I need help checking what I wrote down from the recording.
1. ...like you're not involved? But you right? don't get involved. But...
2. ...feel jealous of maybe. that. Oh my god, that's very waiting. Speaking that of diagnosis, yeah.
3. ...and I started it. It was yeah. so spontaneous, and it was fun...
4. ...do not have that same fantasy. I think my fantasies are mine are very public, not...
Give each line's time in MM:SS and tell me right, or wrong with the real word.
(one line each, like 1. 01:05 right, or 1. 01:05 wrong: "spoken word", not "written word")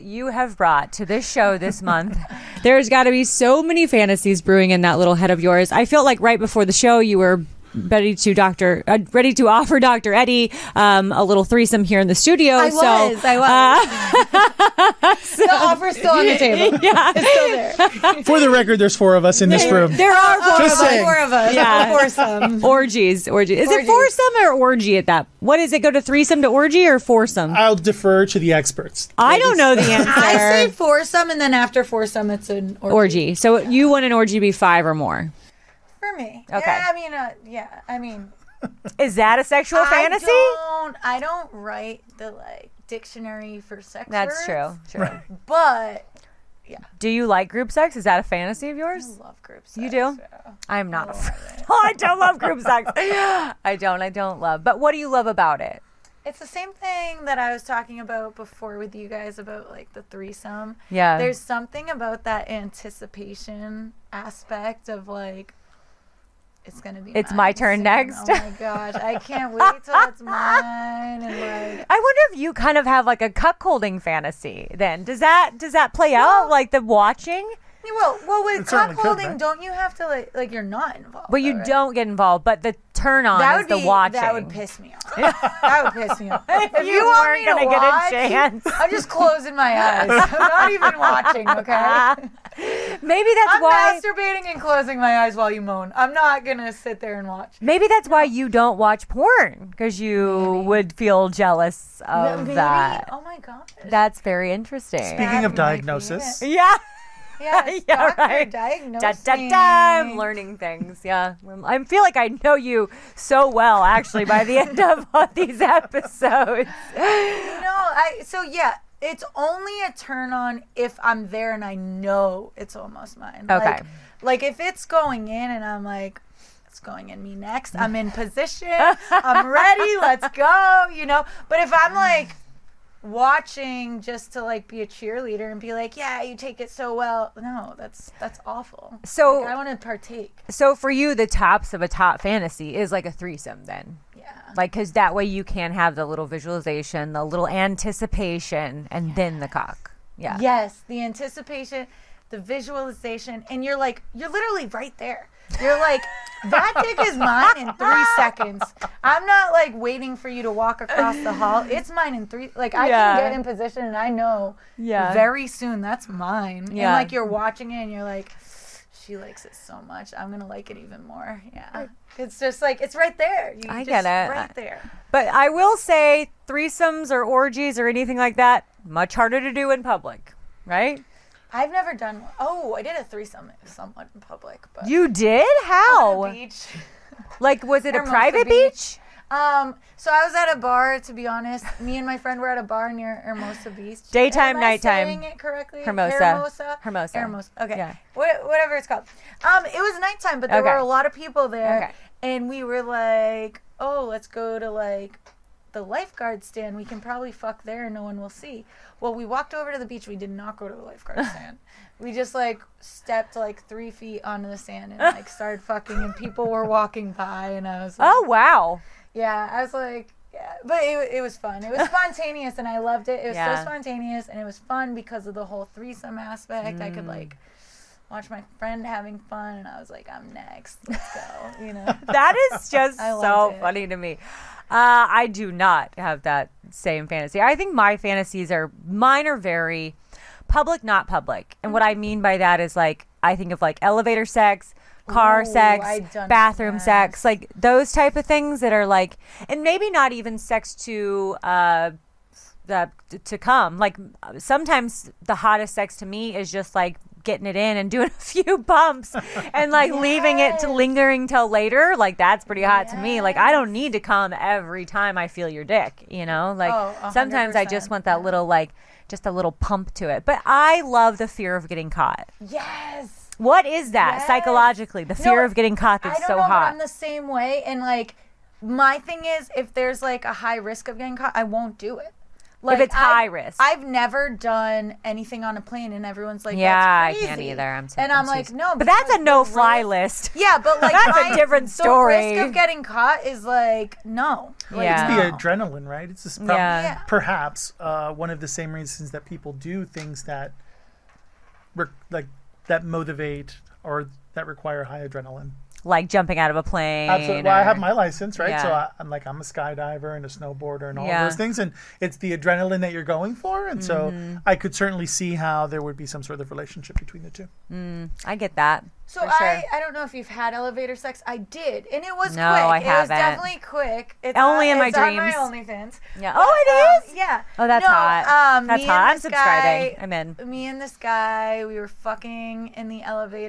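1. 01:20 right
2. 01:40 wrong: "interesting", not "waiting"
3. 03:42 wrong: "loved", not "started"
4. 03:55 right.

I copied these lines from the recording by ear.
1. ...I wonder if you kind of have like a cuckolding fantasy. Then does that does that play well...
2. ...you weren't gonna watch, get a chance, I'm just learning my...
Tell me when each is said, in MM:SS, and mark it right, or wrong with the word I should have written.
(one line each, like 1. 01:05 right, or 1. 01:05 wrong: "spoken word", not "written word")
1. 01:11 right
2. 01:26 wrong: "closing", not "learning".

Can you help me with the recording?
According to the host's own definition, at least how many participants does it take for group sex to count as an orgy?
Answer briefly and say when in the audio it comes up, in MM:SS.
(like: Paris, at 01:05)
5, at 00:34.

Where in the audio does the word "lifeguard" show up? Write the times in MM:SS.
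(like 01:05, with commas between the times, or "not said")
03:25, 03:30.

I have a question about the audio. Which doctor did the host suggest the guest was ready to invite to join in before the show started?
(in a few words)
Dr. Eddie.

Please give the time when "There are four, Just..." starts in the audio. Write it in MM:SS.
00:19.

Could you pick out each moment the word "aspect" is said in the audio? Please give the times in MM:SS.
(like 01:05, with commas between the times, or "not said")
01:04, 03:46.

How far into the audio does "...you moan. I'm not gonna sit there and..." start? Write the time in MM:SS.
01:35.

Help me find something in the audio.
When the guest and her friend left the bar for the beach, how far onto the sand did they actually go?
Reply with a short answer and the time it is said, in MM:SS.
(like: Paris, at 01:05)
3 feet, at 03:33.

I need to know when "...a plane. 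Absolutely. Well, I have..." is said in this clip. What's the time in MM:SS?
05:06.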